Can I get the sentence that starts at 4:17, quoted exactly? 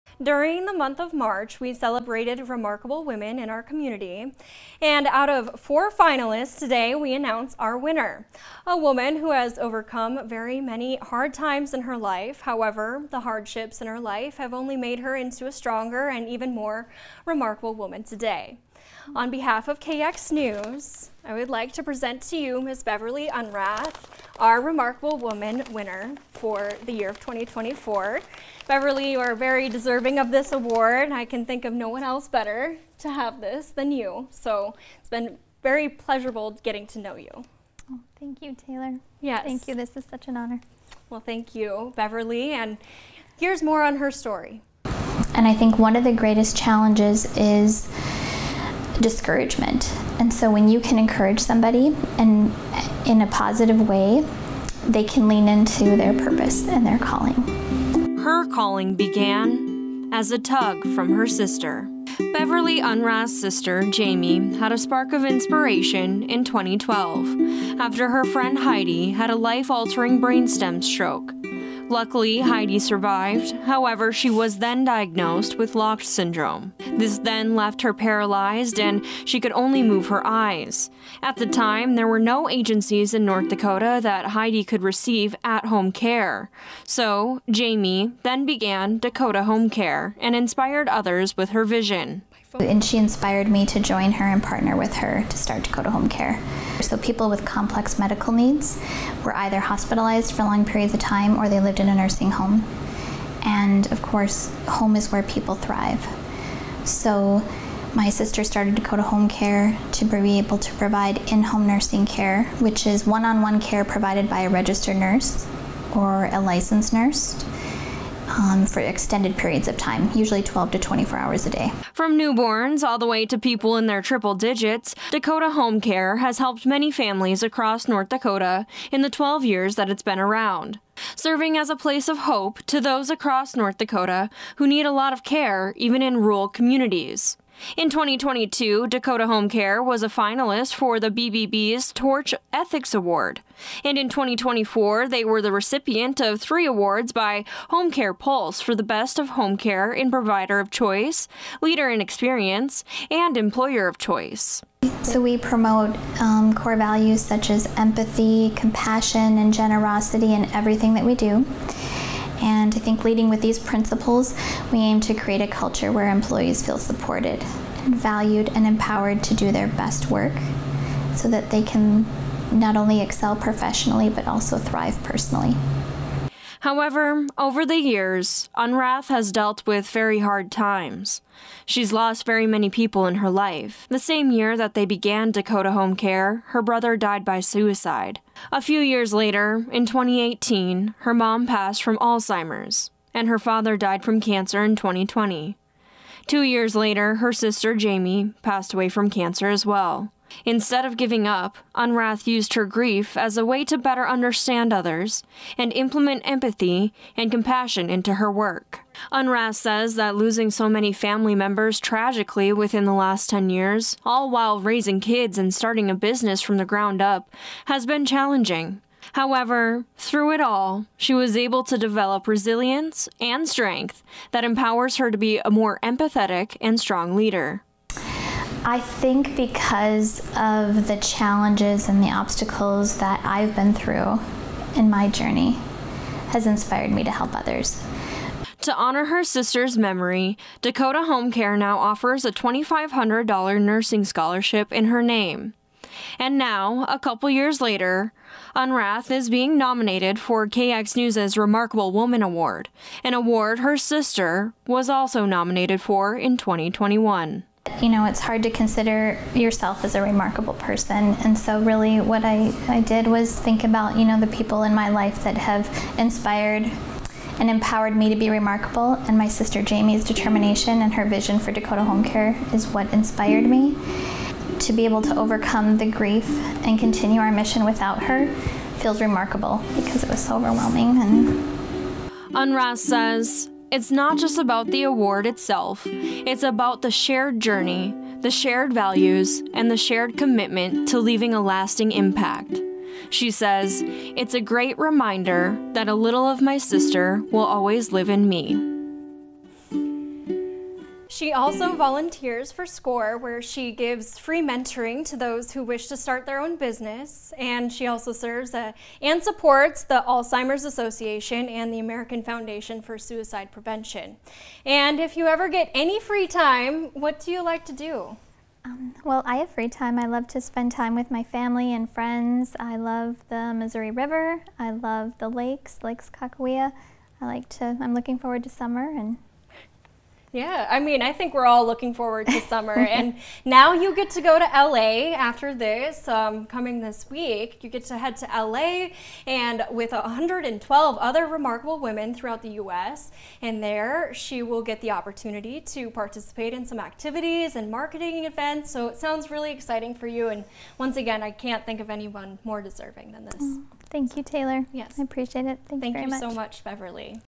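You know, it's hard to consider yourself as a remarkable person.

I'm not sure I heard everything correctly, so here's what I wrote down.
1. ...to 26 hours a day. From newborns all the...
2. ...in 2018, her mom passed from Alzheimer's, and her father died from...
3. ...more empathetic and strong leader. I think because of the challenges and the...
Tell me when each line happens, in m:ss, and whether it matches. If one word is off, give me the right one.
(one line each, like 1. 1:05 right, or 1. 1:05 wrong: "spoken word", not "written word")
1. 2:00 wrong: "24", not "26"
2. 3:09 right
3. 3:45 right.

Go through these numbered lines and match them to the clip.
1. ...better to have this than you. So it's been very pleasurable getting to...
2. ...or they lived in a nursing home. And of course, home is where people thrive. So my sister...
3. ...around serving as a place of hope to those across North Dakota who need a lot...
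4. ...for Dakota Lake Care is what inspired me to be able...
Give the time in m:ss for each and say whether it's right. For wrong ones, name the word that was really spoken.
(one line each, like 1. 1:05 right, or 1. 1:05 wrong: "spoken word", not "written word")
1. 0:32 right
2. 1:41 right
3. 2:10 right
4. 4:31 wrong: "Home", not "Lake".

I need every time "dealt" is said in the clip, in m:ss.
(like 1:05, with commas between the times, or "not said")
2:59.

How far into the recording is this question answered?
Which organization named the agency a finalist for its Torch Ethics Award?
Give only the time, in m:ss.
2:21.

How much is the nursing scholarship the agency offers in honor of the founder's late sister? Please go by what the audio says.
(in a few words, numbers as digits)
$2,500.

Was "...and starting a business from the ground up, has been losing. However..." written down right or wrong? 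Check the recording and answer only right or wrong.
wrong.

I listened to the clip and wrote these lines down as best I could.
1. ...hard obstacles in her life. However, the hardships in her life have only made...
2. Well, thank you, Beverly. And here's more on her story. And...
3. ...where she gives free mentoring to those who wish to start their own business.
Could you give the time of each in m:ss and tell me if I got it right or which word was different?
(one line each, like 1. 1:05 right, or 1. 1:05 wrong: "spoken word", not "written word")
1. 0:10 wrong: "times", not "obstacles"
2. 0:41 right
3. 5:03 right.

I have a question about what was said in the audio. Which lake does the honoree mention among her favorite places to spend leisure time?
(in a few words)
Lake Sakakawea.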